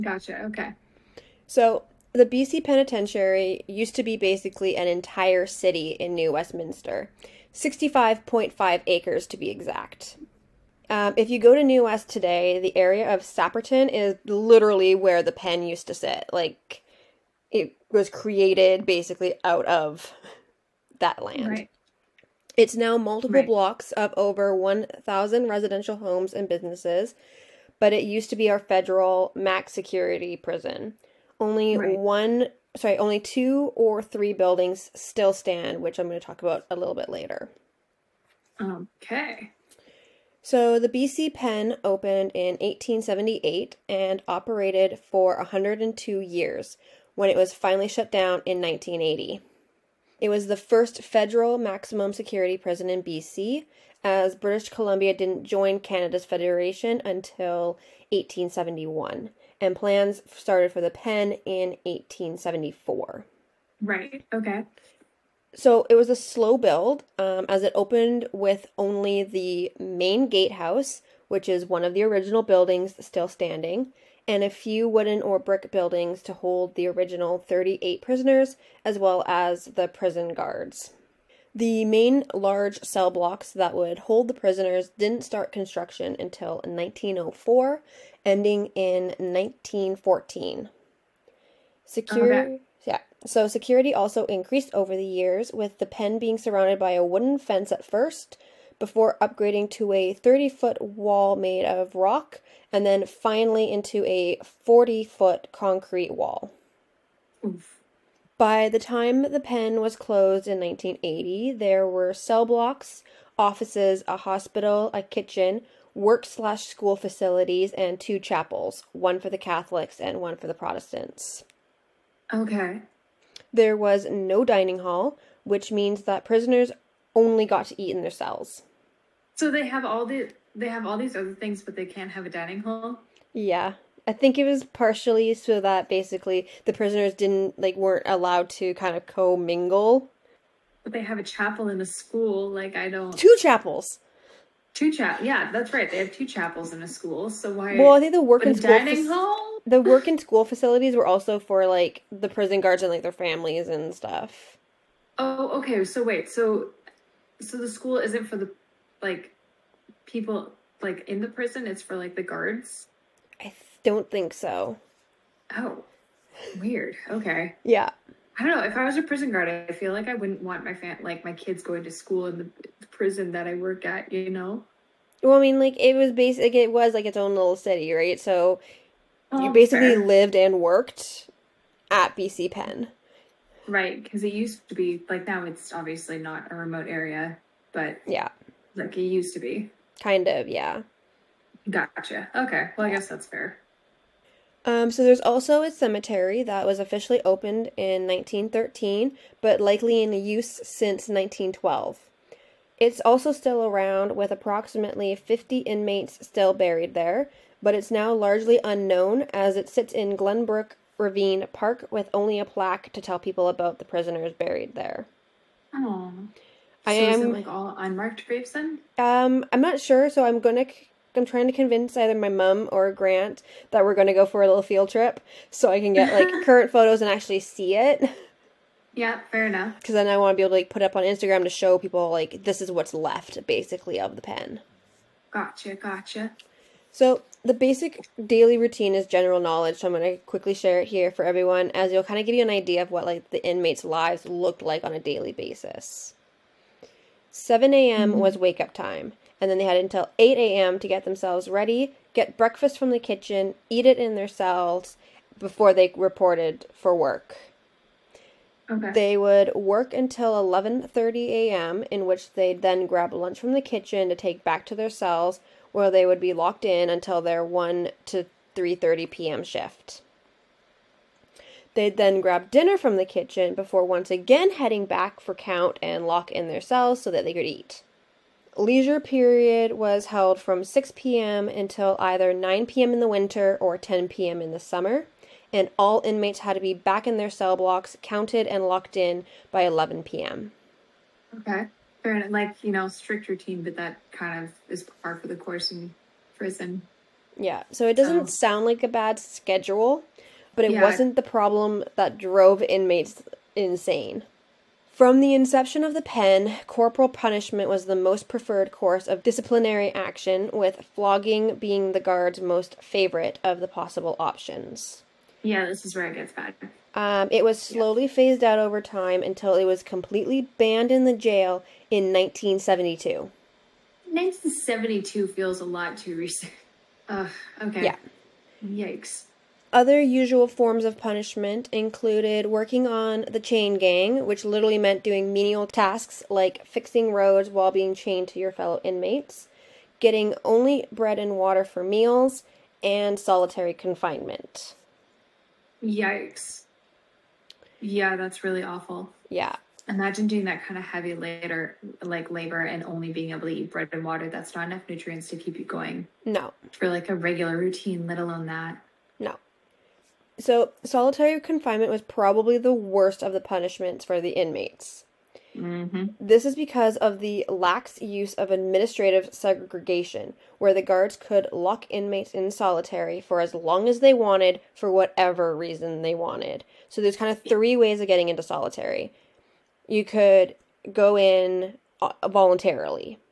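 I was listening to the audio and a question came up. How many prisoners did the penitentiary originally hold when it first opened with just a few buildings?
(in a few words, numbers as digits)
38.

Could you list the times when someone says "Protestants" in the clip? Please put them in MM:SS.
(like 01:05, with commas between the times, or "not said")
02:00.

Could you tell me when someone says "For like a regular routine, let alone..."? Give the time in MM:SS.
05:56.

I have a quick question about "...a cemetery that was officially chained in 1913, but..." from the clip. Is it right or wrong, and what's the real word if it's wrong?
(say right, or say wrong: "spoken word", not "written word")
wrong: "opened", not "chained".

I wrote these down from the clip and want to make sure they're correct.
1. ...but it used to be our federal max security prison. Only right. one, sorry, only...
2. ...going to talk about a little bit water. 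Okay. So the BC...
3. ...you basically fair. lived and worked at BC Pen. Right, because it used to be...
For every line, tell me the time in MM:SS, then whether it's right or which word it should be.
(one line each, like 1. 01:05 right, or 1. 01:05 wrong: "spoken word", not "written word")
1. 00:27 right
2. 00:36 wrong: "later", not "water"
3. 02:59 right.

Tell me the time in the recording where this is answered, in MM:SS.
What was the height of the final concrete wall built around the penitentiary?
01:44.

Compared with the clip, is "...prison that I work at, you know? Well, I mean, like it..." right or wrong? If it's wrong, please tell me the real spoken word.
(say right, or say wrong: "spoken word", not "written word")
right.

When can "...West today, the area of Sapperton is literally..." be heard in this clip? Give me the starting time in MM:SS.
00:11.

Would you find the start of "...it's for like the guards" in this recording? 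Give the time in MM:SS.
02:41.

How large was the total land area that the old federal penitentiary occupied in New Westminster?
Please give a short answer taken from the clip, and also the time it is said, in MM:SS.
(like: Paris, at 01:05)
65.5 acres, at 00:07.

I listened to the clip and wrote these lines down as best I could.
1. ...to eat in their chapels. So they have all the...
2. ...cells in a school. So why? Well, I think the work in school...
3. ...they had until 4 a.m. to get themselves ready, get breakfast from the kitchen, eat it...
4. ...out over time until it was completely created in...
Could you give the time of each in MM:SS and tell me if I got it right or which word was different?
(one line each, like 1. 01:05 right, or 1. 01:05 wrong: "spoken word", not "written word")
1. 02:07 wrong: "cells", not "chapels"
2. 02:26 wrong: "chapels", not "cells"
3. 04:09 wrong: "8", not "4"
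4. 05:18 wrong: "banned", not "created".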